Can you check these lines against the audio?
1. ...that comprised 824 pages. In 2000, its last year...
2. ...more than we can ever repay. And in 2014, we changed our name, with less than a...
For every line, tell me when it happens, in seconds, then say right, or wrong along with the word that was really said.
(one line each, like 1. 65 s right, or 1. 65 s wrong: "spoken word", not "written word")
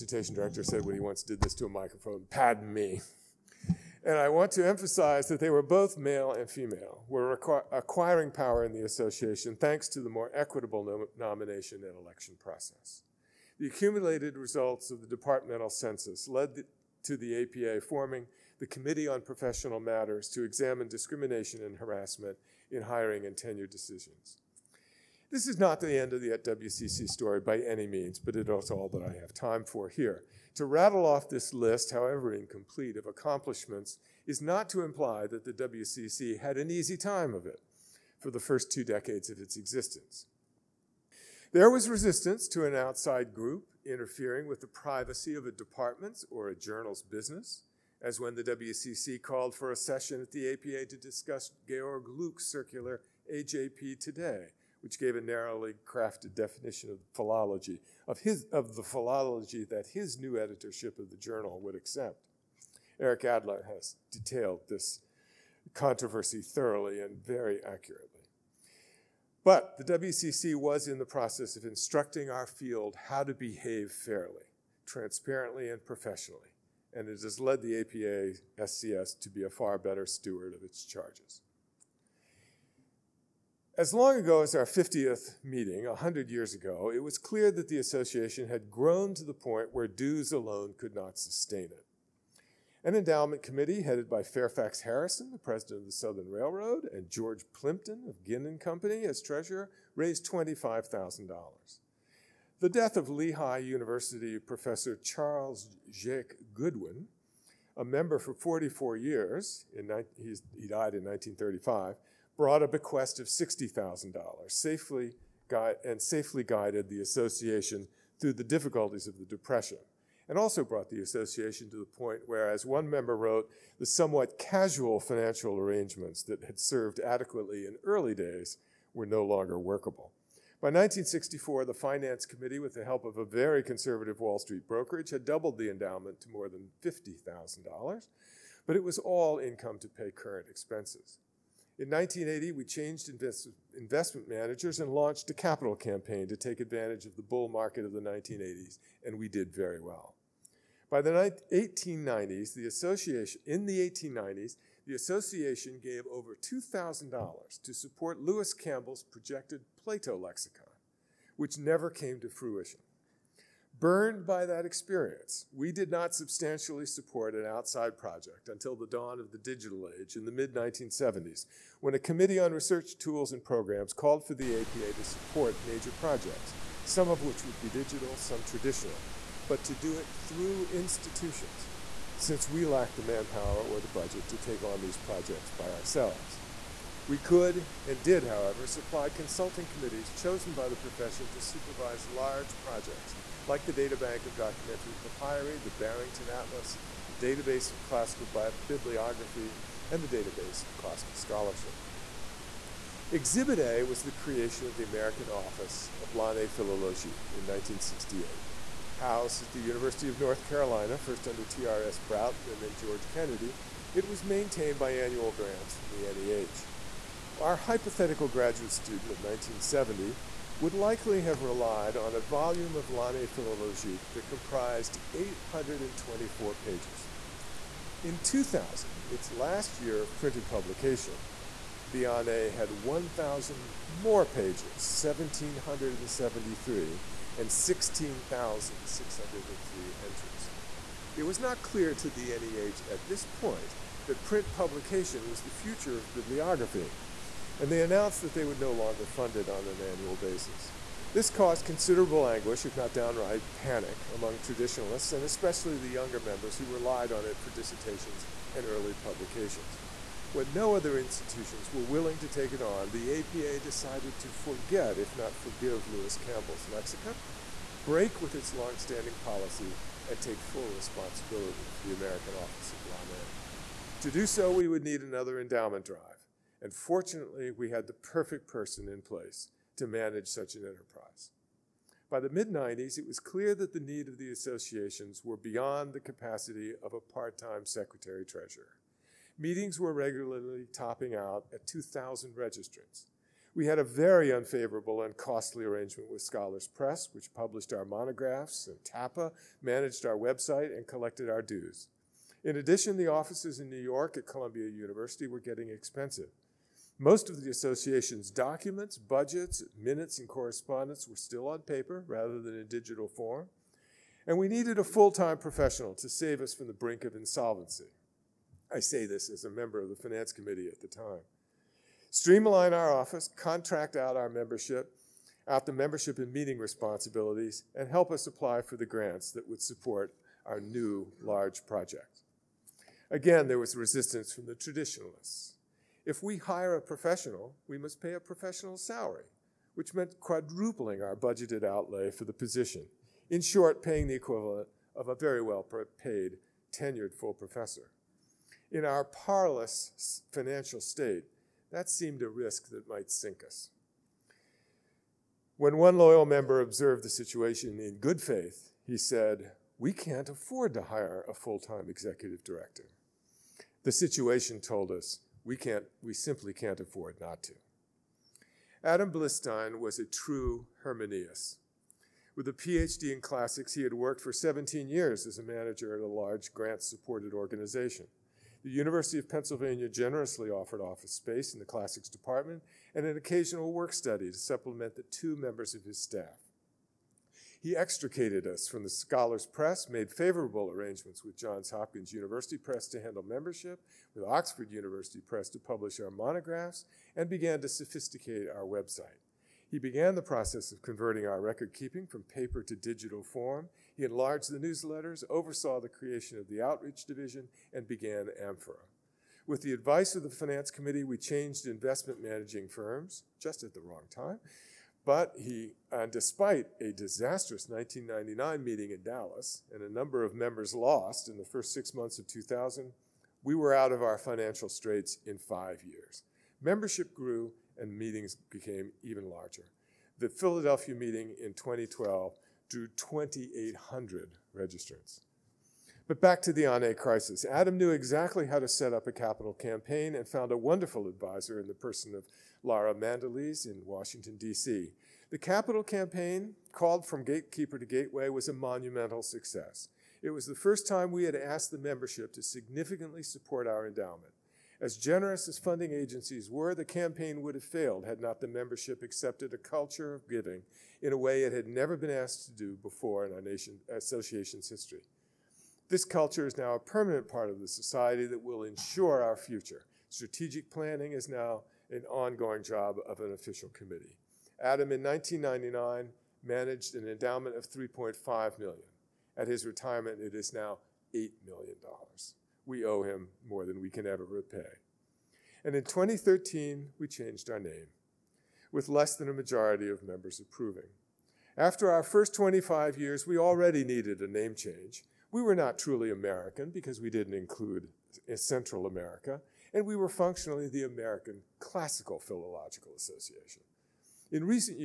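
1. 224 s right
2. 483 s wrong: "2013", not "2014".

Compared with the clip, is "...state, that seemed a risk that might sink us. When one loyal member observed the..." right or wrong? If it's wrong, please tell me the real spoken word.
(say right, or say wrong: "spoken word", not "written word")
right.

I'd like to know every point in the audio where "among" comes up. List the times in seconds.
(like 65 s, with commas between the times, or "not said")
254 s.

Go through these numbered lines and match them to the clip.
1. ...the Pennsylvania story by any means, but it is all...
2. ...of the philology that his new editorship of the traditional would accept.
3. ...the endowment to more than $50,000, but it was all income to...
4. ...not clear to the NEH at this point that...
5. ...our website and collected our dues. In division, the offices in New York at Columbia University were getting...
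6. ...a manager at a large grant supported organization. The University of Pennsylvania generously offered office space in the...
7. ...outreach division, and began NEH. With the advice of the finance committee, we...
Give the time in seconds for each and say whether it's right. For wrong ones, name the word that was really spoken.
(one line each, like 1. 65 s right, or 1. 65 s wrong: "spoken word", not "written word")
1. 26 s wrong: "WCC", not "Pennsylvania"
2. 58 s wrong: "journal", not "traditional"
3. 135 s right
4. 241 s right
5. 300 s wrong: "addition", not "division"
6. 375 s right
7. 406 s wrong: "Amphora", not "NEH".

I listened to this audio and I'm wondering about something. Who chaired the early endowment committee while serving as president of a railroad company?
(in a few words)
Fairfax Harrison.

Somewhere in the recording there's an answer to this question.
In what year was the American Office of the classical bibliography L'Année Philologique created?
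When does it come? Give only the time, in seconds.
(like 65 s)
207 s.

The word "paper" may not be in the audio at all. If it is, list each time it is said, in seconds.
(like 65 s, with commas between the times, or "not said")
311 s, 402 s.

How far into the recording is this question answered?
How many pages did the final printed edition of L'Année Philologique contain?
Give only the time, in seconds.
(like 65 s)
235 s.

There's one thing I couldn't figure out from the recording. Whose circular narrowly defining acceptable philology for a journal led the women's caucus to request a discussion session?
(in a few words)
Georg Luck.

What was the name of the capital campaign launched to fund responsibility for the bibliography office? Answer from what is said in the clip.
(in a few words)
From Gatekeeper to Gateway.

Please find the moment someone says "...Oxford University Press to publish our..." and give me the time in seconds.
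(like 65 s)
394 s.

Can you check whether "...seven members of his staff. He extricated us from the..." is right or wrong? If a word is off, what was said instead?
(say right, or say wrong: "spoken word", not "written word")
wrong: "two", not "seven".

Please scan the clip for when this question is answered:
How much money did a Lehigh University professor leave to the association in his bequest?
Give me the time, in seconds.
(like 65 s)
113 s.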